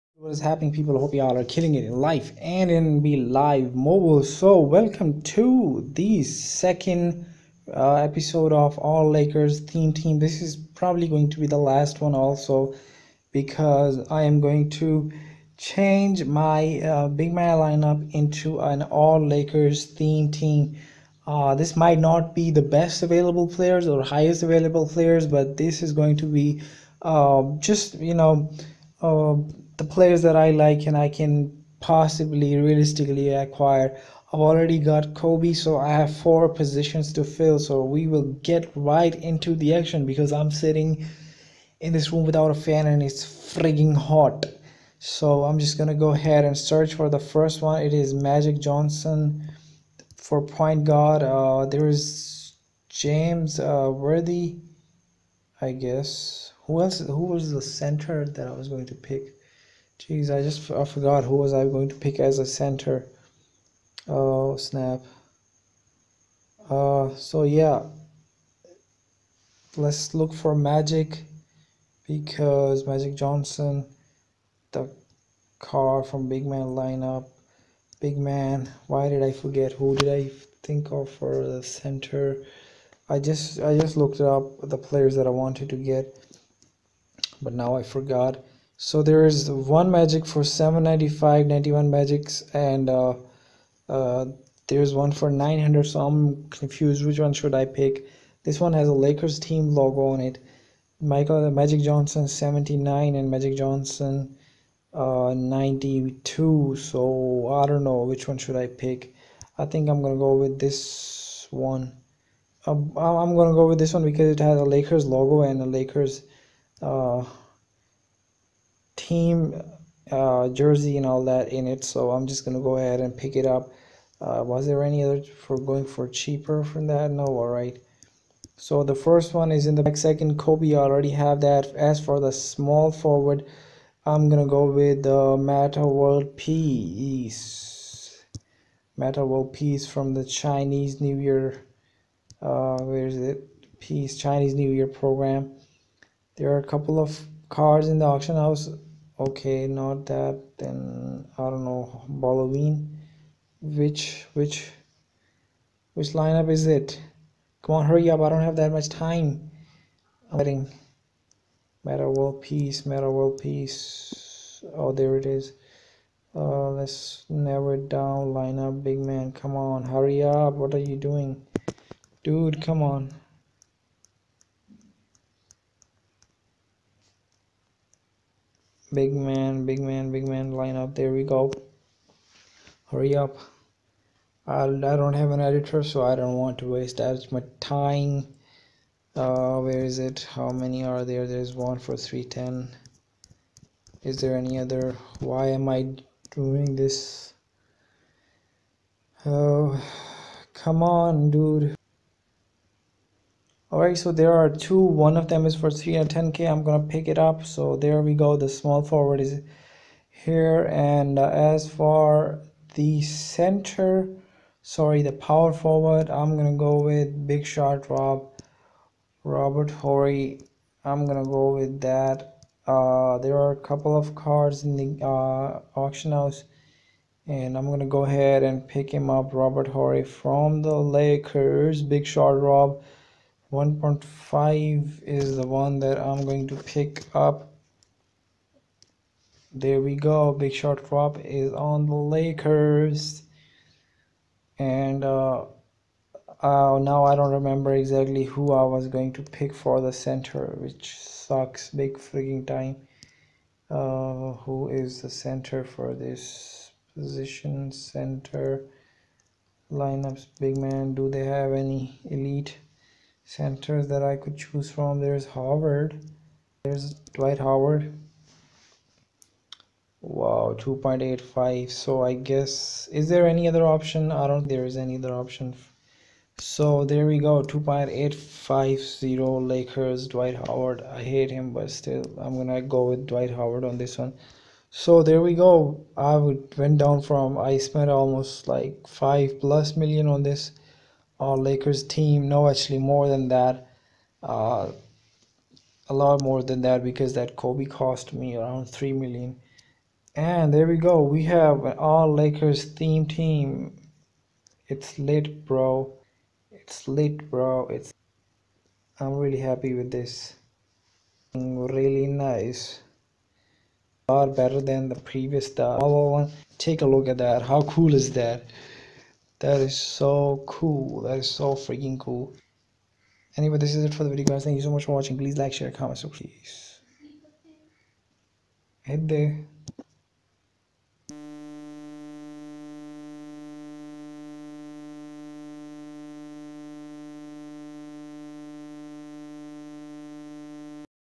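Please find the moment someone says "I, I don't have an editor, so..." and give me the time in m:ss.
3:04.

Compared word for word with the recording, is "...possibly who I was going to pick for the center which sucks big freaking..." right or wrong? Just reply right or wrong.
wrong.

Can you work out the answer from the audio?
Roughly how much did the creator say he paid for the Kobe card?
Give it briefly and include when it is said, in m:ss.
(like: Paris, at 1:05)
3 million, at 4:58.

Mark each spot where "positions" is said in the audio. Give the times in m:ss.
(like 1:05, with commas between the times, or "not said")
0:36, 4:16.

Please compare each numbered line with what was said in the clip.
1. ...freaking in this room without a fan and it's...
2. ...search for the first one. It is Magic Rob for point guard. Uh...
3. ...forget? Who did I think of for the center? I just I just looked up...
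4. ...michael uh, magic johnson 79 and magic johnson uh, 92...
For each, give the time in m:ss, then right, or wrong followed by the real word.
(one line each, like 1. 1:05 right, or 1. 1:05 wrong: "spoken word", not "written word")
1. 0:40 wrong: "sitting", not "freaking"
2. 0:46 wrong: "Johnson", not "Rob"
3. 1:19 right
4. 1:40 right.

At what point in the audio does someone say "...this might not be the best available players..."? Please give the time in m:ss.
0:21.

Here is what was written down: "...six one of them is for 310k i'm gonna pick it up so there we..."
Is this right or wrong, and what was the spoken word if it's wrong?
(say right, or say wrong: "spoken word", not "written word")
wrong: "two", not "six".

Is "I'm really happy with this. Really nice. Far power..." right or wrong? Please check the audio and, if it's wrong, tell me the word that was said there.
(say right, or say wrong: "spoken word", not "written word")
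wrong: "better", not "power".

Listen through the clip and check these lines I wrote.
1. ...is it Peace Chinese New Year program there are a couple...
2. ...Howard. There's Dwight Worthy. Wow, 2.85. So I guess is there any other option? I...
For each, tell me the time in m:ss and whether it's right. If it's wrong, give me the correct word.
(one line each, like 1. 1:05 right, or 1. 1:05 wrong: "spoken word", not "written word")
1. 2:23 right
2. 4:25 wrong: "Howard", not "Worthy".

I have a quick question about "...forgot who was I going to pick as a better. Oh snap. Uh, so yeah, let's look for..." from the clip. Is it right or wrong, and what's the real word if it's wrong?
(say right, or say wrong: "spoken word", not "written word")
wrong: "center", not "better".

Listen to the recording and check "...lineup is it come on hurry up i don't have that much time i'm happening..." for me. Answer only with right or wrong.
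wrong.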